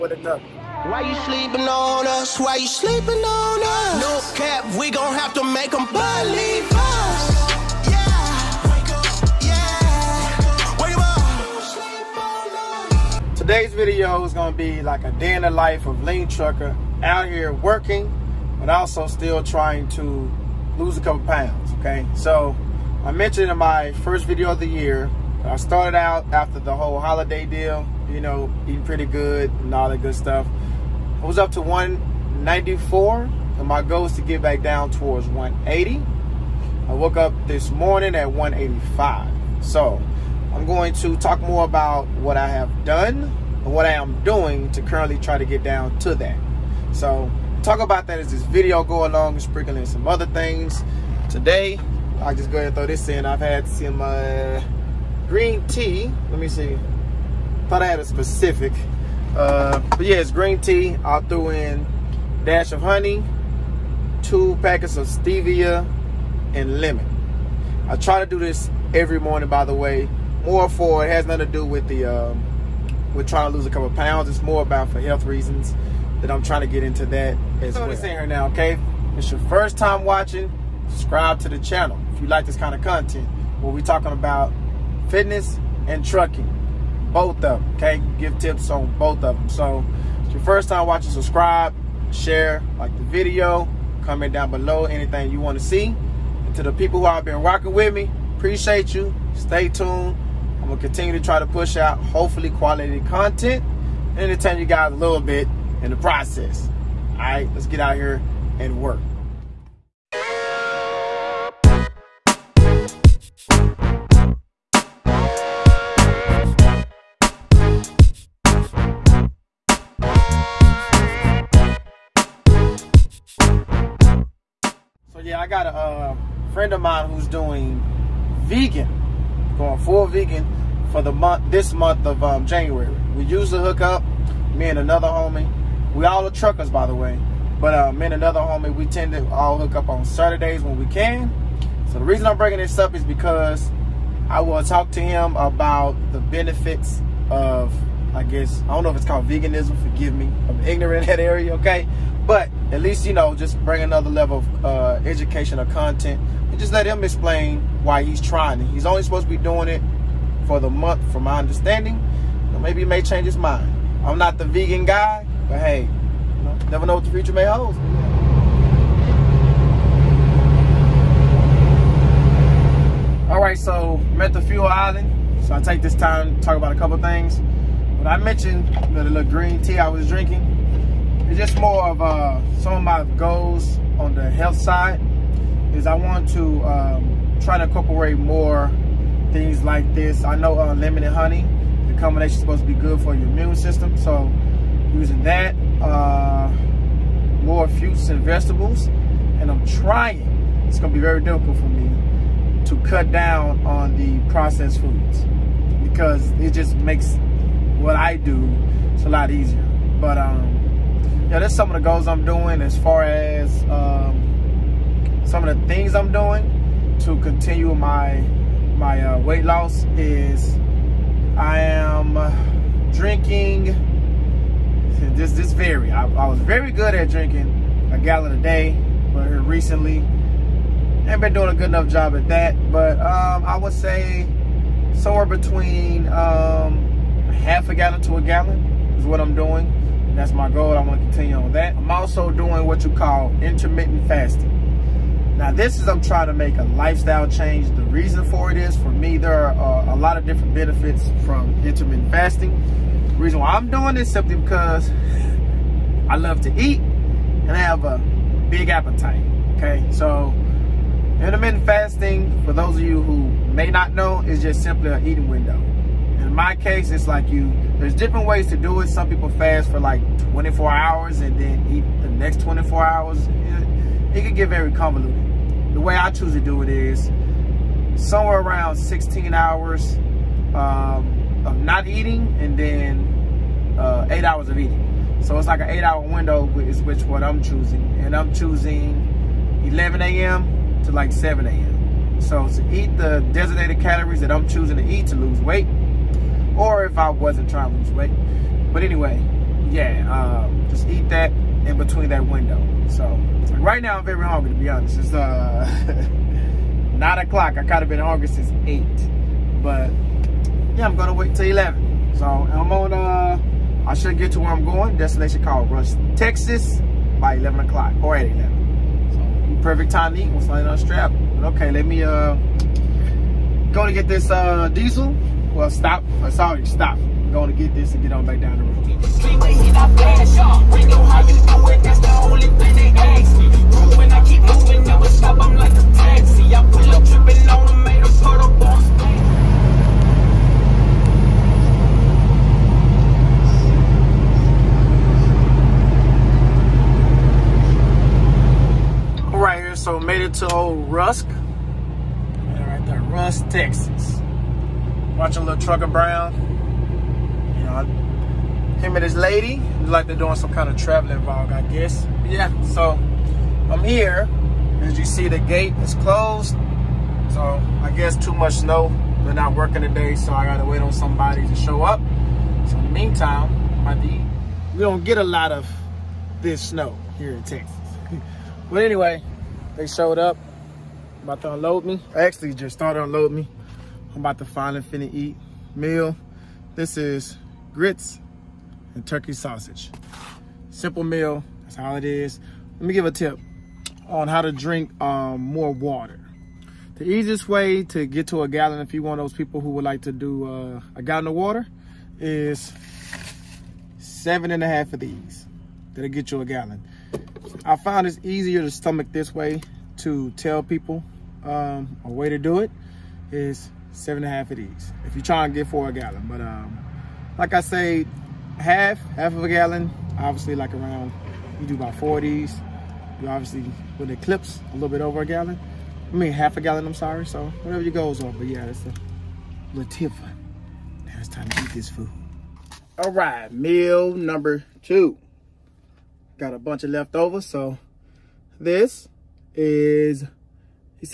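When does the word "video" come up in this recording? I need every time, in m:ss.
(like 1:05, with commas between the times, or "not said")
0:13, 0:24, 0:48, 1:33.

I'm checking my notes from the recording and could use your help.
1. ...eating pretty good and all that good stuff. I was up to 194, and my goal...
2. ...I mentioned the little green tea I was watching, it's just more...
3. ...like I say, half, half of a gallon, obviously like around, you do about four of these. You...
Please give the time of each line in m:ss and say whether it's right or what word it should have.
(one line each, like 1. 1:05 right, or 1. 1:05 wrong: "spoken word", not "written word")
1. 0:28 right
2. 2:58 wrong: "drinking", not "watching"
3. 6:57 right.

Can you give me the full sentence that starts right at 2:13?
We to hook up, me and another homie.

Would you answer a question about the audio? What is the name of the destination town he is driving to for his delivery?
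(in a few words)
Rush, Texas.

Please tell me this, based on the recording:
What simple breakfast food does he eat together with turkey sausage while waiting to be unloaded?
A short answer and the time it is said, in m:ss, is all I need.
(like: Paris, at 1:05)
Grits, at 6:27.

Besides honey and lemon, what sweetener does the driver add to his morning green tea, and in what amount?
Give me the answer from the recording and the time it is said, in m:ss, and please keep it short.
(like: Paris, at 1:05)
2 packets of stevia, at 1:04.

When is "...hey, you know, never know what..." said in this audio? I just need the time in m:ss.
2:45.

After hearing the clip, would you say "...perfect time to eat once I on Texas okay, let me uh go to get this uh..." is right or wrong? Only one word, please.
wrong.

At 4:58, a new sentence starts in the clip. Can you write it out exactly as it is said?
But anyway, yeah, um, just eat that in between that window.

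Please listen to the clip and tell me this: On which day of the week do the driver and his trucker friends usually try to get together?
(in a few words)
Saturdays.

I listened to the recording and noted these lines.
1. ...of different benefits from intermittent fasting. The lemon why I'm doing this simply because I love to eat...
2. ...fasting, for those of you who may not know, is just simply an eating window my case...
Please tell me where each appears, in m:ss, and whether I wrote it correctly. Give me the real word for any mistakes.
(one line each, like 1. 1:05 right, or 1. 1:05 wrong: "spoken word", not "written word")
1. 4:10 wrong: "reason", not "lemon"
2. 4:21 right.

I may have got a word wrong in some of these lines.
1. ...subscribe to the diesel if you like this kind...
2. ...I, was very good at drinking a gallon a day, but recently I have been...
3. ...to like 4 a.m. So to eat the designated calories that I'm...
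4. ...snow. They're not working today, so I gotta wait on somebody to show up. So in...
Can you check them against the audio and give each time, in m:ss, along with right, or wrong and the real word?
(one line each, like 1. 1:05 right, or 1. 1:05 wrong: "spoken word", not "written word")
1. 1:20 wrong: "channel", not "diesel"
2. 3:46 right
3. 4:50 wrong: "7", not "4"
4. 6:08 right.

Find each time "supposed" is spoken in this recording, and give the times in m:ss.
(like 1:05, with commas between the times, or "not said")
2:39, 3:12.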